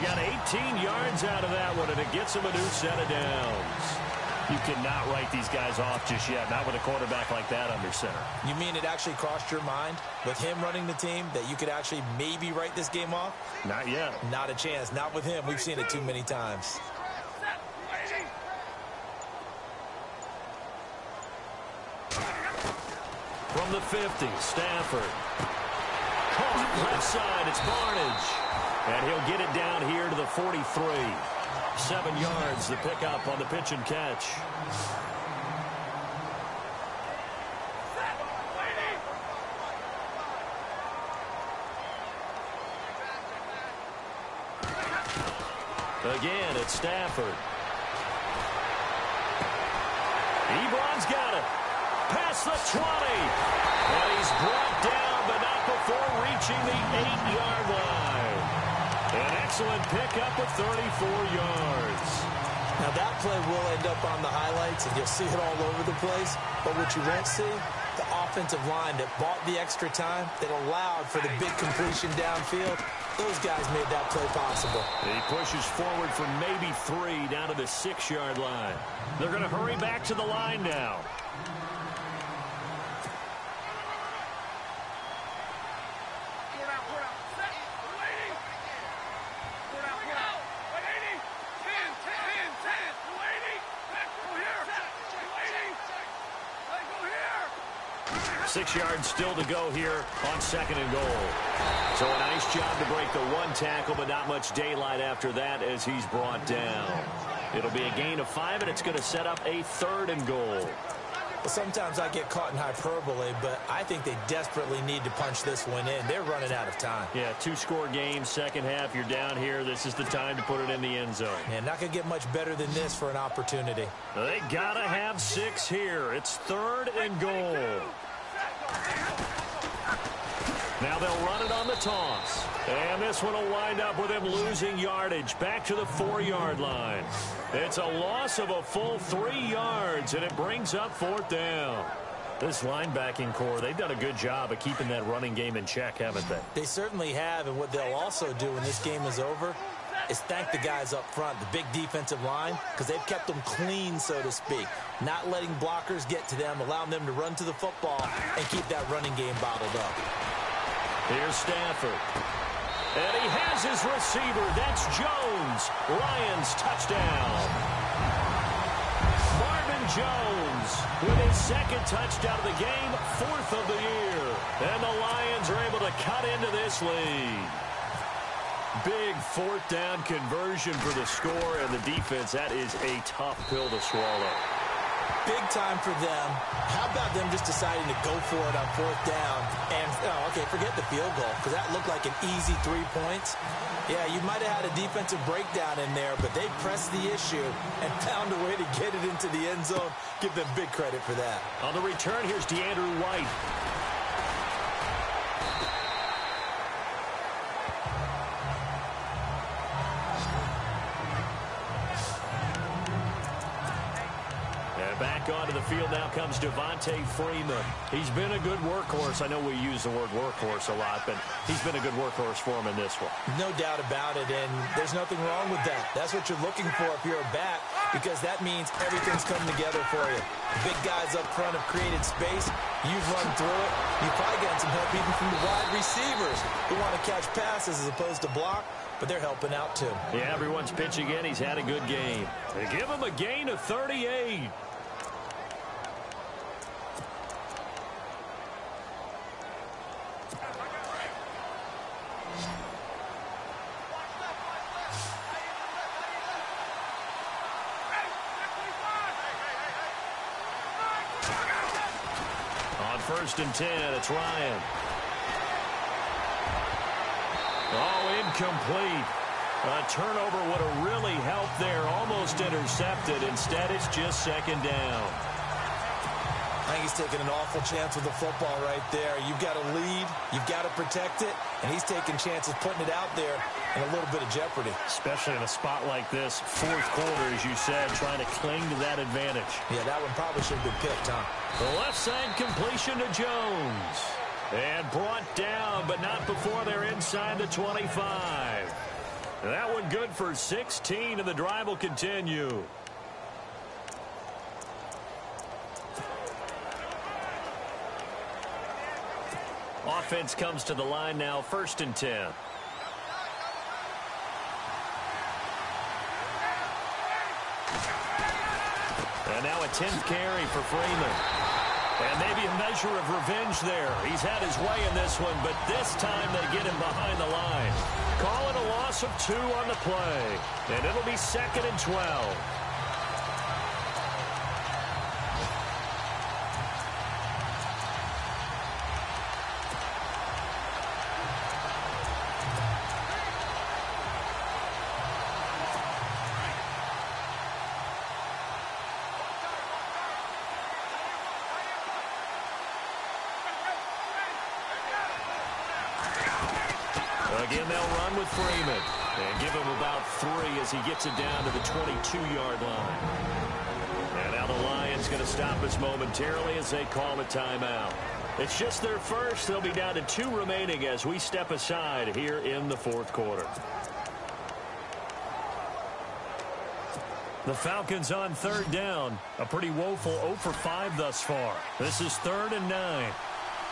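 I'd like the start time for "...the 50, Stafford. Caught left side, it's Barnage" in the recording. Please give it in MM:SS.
00:23.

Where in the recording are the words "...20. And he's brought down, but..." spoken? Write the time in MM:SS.
00:52.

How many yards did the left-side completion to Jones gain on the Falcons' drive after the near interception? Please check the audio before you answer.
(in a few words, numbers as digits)
16.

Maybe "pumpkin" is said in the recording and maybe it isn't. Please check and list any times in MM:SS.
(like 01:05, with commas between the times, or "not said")
not said.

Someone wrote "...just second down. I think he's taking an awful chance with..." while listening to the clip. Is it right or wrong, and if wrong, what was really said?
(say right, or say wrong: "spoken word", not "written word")
right.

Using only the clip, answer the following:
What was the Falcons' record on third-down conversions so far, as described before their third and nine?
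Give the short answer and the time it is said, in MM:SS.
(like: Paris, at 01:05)
0 for 5, at 06:20.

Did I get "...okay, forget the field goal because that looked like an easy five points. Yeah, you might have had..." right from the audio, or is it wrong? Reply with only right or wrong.
wrong.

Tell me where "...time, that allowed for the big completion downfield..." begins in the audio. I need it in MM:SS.
01:09.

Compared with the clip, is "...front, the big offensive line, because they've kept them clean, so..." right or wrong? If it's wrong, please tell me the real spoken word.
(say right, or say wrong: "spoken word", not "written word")
wrong: "defensive", not "offensive".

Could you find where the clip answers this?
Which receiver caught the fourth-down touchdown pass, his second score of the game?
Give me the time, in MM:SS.
02:49.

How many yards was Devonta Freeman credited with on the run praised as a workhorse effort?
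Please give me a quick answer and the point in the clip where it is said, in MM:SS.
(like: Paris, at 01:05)
38, at 04:03.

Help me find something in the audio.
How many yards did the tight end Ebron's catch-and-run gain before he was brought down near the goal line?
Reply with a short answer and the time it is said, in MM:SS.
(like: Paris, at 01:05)
34, at 01:00.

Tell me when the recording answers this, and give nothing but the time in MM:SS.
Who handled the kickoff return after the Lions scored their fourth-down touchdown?
03:22.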